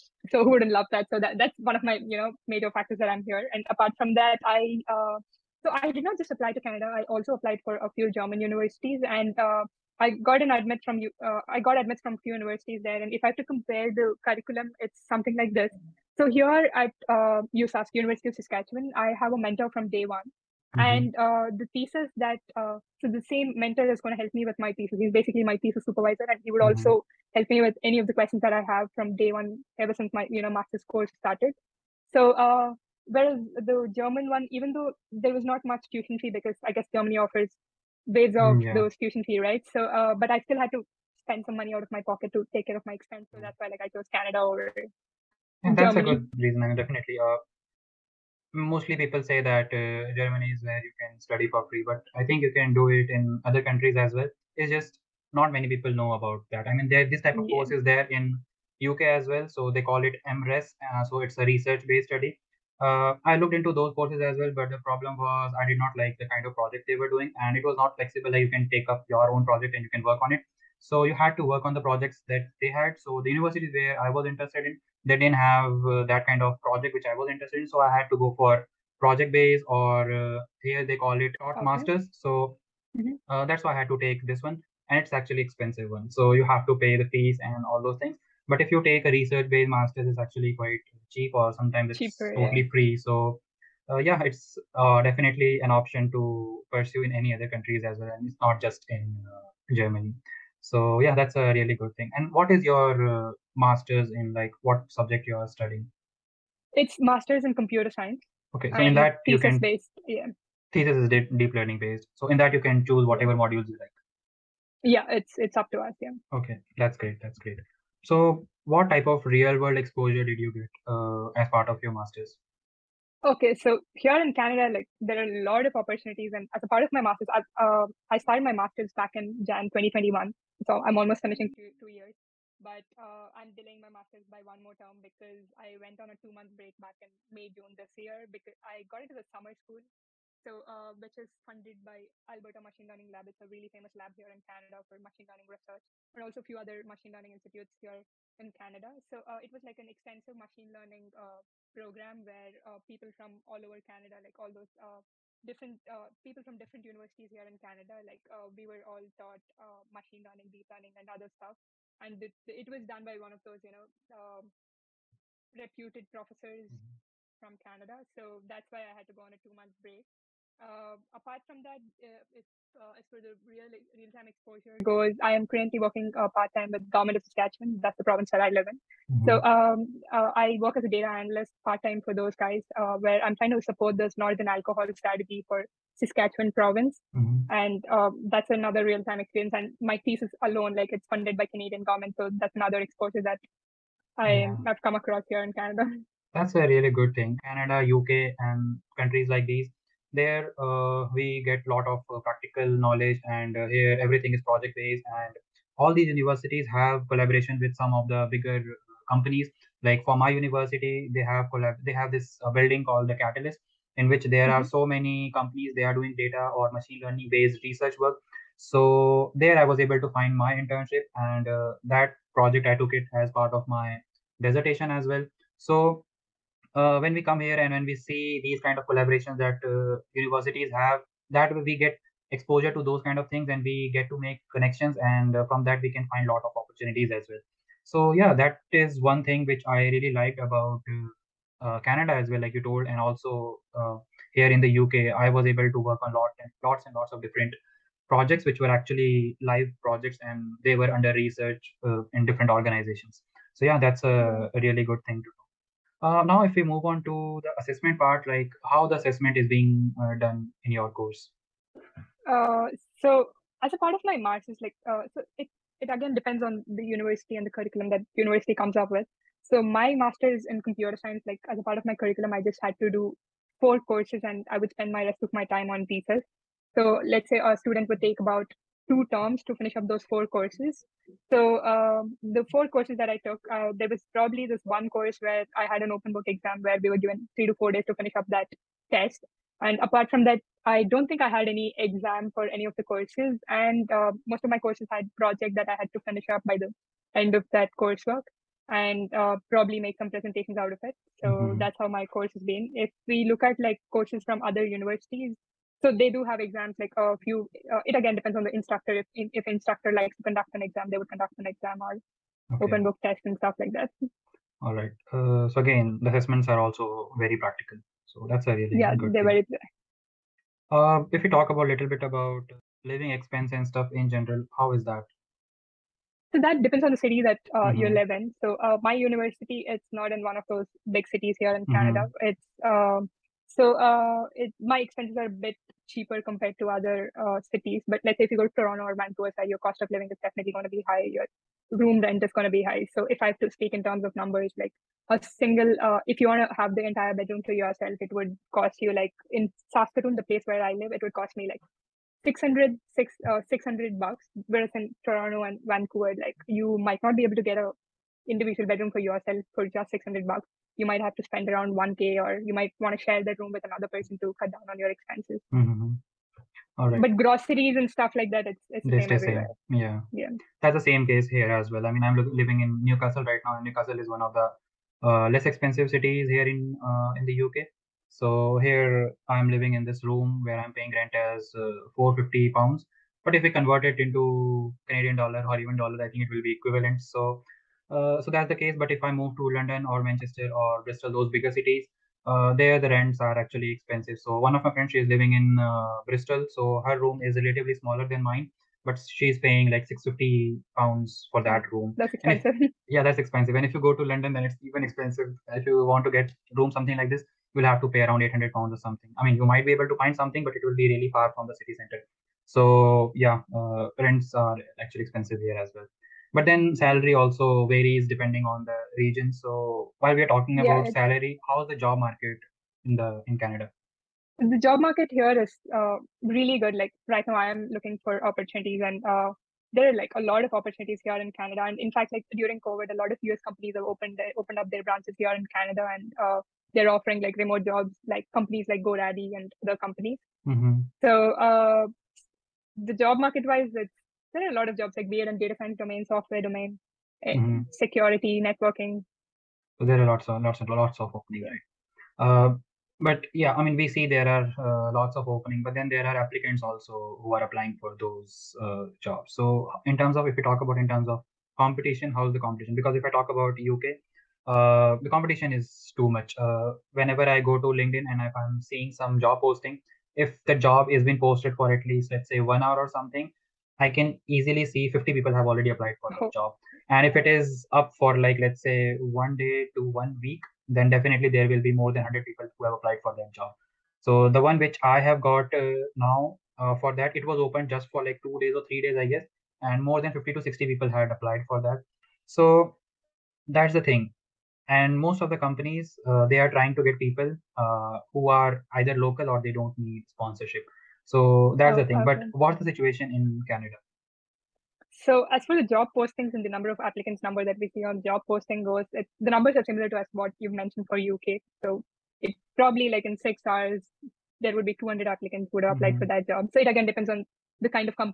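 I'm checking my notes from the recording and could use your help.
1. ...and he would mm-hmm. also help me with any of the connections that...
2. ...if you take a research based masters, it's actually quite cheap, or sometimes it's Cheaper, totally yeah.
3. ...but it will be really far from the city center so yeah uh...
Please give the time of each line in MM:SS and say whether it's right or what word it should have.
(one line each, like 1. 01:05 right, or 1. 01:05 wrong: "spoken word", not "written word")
1. 00:26 wrong: "questions", not "connections"
2. 01:28 right
3. 06:50 right.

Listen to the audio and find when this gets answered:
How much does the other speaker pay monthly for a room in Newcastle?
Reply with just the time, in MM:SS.
06:21.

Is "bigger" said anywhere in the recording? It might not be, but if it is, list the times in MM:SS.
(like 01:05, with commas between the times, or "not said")
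03:28, 06:31.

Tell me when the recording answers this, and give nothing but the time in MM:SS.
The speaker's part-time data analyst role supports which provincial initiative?
03:04.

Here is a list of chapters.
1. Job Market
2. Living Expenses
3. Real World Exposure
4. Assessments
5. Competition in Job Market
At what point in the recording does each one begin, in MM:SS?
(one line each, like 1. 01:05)
1. 06:59
2. 05:21
3. 01:56
4. 04:15
5. 07:32.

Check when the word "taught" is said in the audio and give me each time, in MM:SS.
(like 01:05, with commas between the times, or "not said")
01:21, 02:39.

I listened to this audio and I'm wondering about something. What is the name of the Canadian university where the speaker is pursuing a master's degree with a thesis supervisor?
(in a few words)
University of Saskatchewan.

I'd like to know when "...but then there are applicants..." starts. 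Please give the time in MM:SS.
07:35.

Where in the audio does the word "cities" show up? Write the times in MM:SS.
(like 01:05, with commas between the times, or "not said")
05:31, 05:37, 06:15, 06:31.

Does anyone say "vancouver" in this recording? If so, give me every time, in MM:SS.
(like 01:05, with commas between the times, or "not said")
05:39, 05:55.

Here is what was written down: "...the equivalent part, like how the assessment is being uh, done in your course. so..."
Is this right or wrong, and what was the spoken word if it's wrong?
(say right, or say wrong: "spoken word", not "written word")
wrong: "assessment", not "equivalent".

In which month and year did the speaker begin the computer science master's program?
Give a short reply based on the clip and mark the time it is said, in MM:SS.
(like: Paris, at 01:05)
January 2021, at 02:09.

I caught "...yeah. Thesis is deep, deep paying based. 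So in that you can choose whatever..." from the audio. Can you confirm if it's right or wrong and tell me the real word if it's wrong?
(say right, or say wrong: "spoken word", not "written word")
wrong: "learning", not "paying".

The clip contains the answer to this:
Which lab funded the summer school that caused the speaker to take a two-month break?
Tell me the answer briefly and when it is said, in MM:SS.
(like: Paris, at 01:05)
Alberta Machine Learning Lab, at 02:22.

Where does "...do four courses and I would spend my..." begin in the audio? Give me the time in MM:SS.
04:32.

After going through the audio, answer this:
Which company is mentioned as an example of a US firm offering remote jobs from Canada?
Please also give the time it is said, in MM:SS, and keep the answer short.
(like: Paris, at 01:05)
GoDaddy, at 07:18.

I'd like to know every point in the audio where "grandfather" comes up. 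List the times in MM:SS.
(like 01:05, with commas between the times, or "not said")
not said.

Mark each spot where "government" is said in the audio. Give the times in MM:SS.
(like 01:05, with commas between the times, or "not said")
02:56, 03:11.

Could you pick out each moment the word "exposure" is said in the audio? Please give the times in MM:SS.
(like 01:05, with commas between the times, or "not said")
01:59, 02:54, 03:12, 03:52.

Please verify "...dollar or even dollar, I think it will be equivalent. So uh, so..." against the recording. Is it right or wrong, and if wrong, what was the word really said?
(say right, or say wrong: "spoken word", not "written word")
right.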